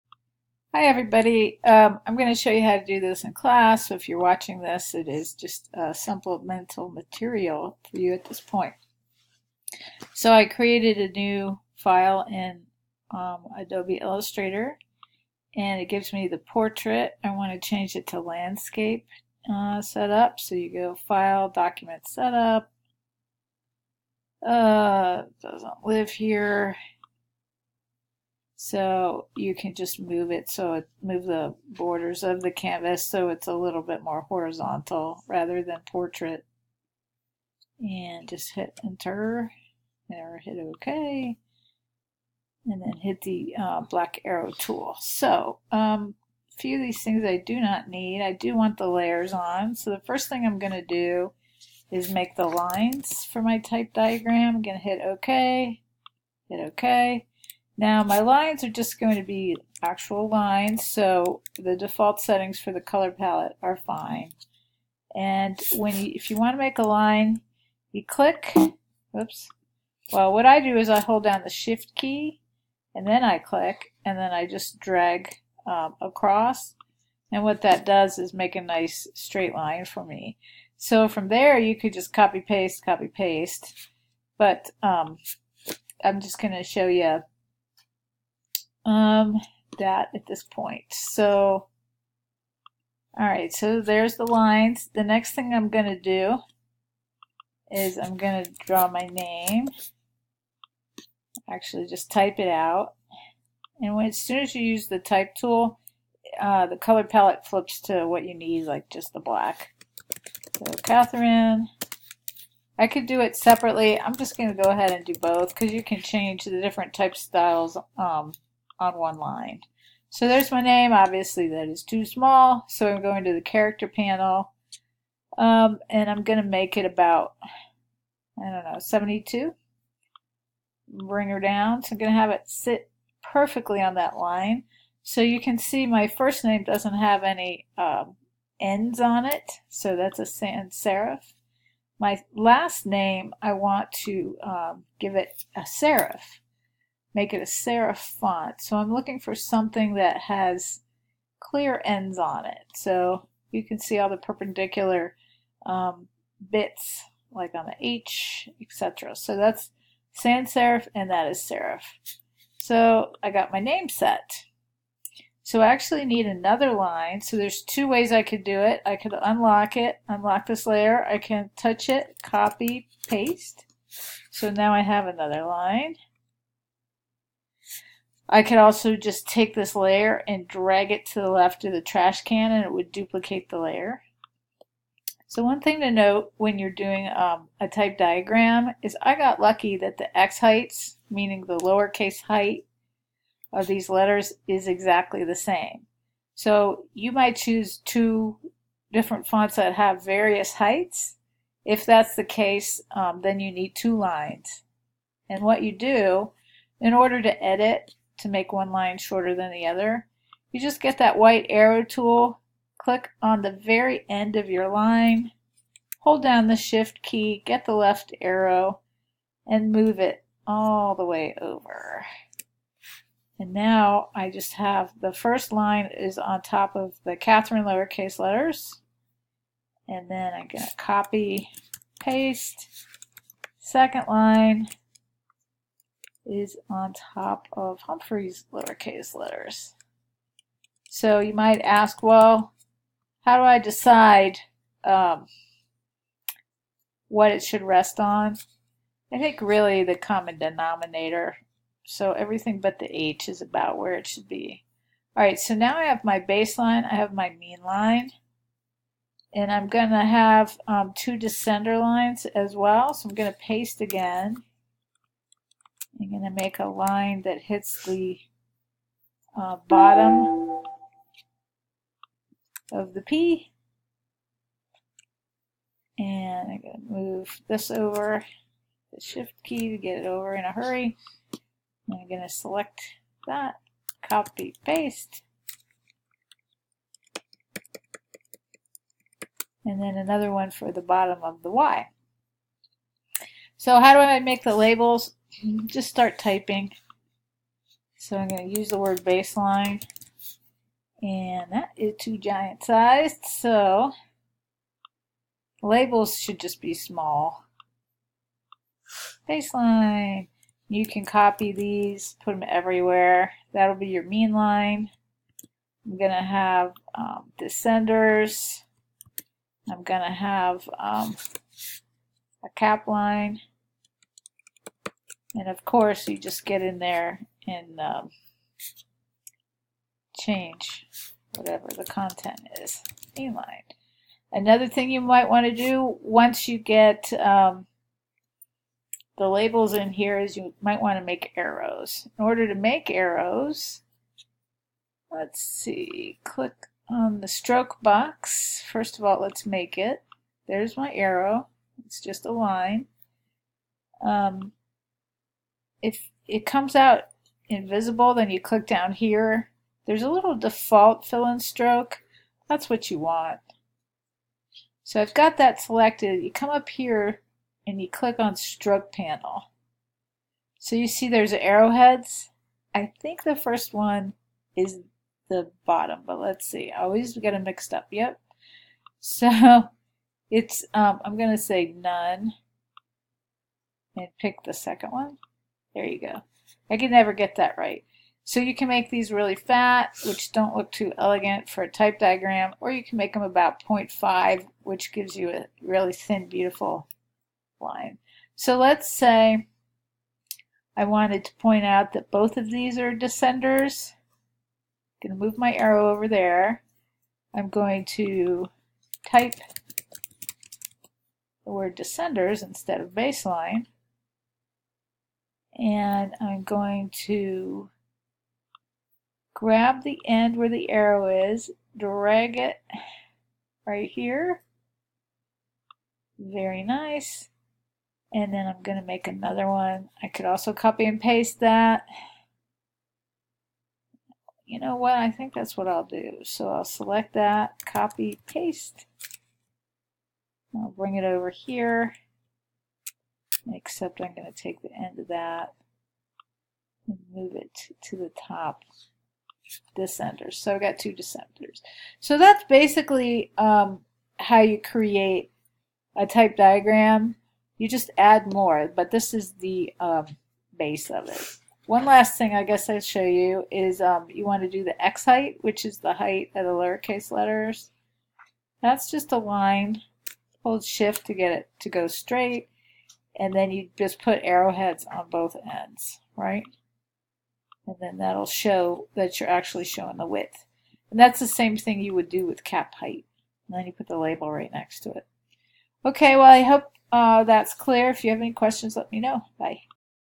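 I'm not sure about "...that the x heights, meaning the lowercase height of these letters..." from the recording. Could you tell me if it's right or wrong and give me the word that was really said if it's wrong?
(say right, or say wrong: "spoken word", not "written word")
right.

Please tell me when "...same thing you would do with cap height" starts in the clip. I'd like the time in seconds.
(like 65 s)
481 s.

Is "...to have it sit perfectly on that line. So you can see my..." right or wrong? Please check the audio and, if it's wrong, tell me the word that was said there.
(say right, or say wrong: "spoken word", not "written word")
right.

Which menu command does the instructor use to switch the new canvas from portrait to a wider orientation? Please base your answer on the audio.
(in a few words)
Document setup.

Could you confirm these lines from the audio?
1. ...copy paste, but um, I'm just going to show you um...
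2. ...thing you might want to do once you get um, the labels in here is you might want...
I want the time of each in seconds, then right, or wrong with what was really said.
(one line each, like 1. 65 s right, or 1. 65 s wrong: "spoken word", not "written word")
1. 82 s right
2. 334 s right.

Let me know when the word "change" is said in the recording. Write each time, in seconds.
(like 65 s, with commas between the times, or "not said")
17 s, 116 s, 330 s.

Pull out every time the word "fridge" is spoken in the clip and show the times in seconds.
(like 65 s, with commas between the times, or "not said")
not said.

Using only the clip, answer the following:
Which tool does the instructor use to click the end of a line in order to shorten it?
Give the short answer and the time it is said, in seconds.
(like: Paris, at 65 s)
White arrow tool, at 211 s.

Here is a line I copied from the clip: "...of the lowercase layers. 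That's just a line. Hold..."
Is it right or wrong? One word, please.
wrong.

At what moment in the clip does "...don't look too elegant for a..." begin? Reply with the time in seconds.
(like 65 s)
390 s.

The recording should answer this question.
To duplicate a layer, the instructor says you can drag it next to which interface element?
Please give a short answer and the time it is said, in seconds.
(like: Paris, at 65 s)
The trash can, at 181 s.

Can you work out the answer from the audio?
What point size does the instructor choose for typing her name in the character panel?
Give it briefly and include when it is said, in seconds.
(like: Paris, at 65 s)
72, at 128 s.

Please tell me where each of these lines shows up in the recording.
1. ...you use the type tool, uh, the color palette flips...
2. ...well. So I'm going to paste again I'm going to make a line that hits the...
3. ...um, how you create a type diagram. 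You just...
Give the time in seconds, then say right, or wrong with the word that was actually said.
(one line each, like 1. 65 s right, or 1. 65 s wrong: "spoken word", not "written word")
1. 104 s right
2. 262 s right
3. 453 s right.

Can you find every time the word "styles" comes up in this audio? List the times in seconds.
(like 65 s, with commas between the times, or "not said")
117 s.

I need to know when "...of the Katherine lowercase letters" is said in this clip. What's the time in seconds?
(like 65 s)
226 s.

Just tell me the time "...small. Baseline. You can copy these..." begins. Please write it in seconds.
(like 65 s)
306 s.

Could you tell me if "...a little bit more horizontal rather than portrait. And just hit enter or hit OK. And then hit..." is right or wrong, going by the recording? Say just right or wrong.
right.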